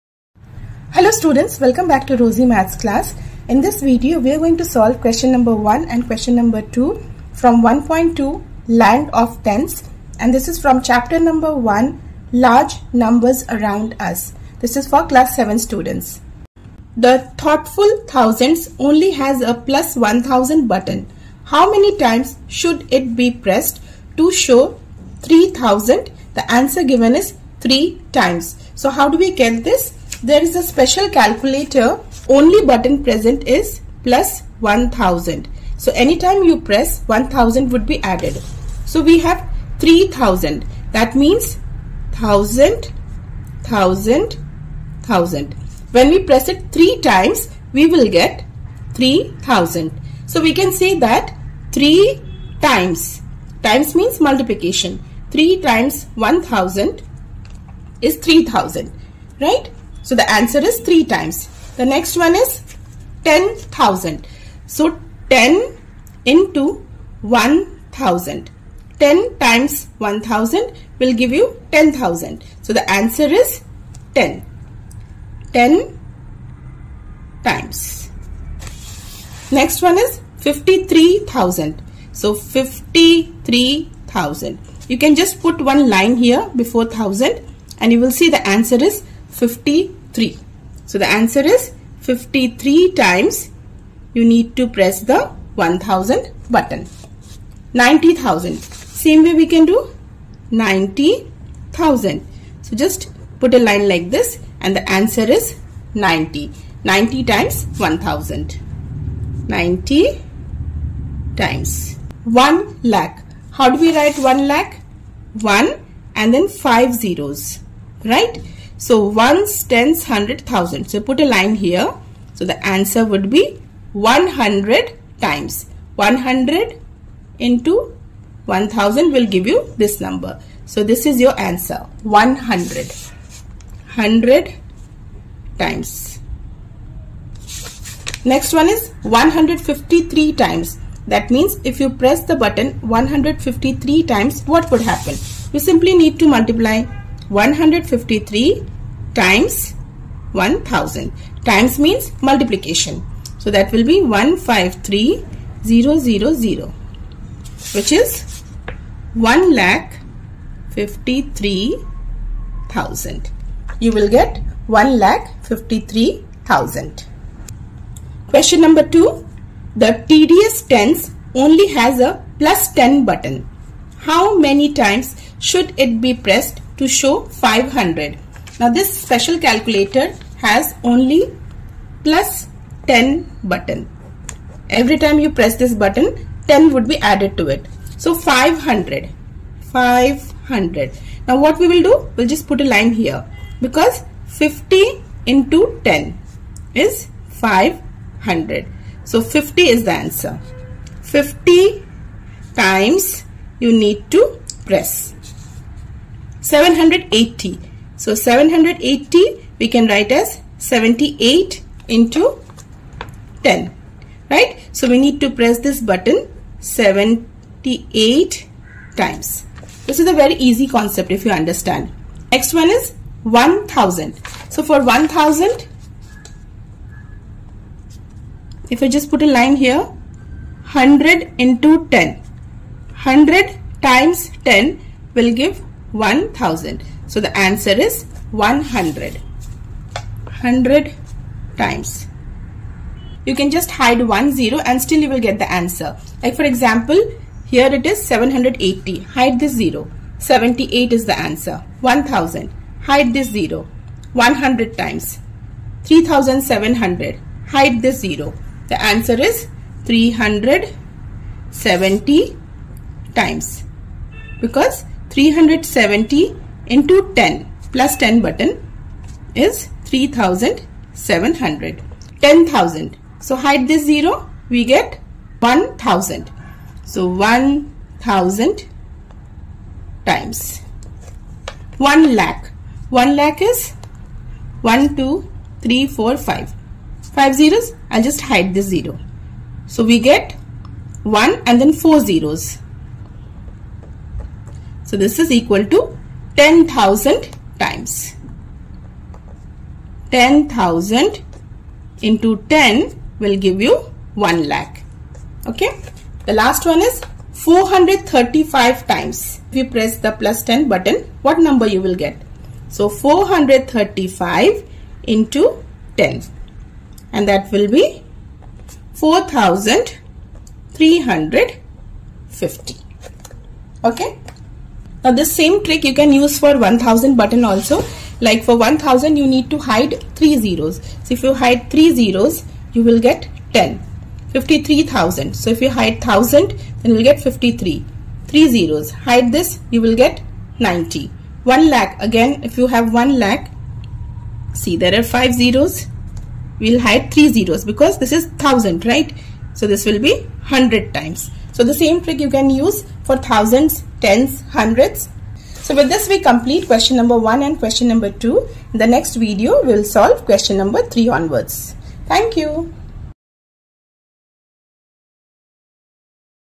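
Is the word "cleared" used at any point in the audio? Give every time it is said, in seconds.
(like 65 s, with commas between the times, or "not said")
not said.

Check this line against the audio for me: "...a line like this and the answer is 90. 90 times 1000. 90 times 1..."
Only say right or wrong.
right.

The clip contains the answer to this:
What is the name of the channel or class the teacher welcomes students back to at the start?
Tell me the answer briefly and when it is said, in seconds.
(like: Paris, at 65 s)
Rosey Maths, at 2 s.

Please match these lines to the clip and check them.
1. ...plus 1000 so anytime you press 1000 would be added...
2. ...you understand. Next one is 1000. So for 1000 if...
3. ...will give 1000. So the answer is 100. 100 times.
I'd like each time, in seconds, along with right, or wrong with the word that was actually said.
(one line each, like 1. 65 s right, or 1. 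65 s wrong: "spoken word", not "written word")
1. 34 s right
2. 221 s right
3. 235 s right.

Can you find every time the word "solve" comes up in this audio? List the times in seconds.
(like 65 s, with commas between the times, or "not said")
4 s, 359 s.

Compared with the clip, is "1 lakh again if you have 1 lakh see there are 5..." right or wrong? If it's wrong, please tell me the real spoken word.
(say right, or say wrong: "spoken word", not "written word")
right.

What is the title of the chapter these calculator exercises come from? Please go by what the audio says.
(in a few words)
Large Numbers Around Us.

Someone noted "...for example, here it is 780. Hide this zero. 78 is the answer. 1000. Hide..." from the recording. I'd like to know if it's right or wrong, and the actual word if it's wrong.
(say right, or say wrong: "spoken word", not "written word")
right.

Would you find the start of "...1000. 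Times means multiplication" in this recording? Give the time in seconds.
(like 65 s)
150 s.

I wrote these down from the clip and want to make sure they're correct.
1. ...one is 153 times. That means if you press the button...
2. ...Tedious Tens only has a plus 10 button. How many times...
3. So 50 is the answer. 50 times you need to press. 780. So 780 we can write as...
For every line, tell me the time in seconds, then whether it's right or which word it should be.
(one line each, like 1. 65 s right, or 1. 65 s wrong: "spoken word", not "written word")
1. 138 s right
2. 170 s right
3. 199 s right.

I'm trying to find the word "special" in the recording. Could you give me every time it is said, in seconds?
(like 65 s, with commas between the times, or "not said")
30 s, 179 s.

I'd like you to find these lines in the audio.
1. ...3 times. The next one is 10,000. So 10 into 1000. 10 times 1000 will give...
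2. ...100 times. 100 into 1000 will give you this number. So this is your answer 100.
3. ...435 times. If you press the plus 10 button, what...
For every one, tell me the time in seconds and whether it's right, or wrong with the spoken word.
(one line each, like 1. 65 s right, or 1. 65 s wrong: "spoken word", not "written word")
1. 60 s right
2. 123 s right
3. 307 s right.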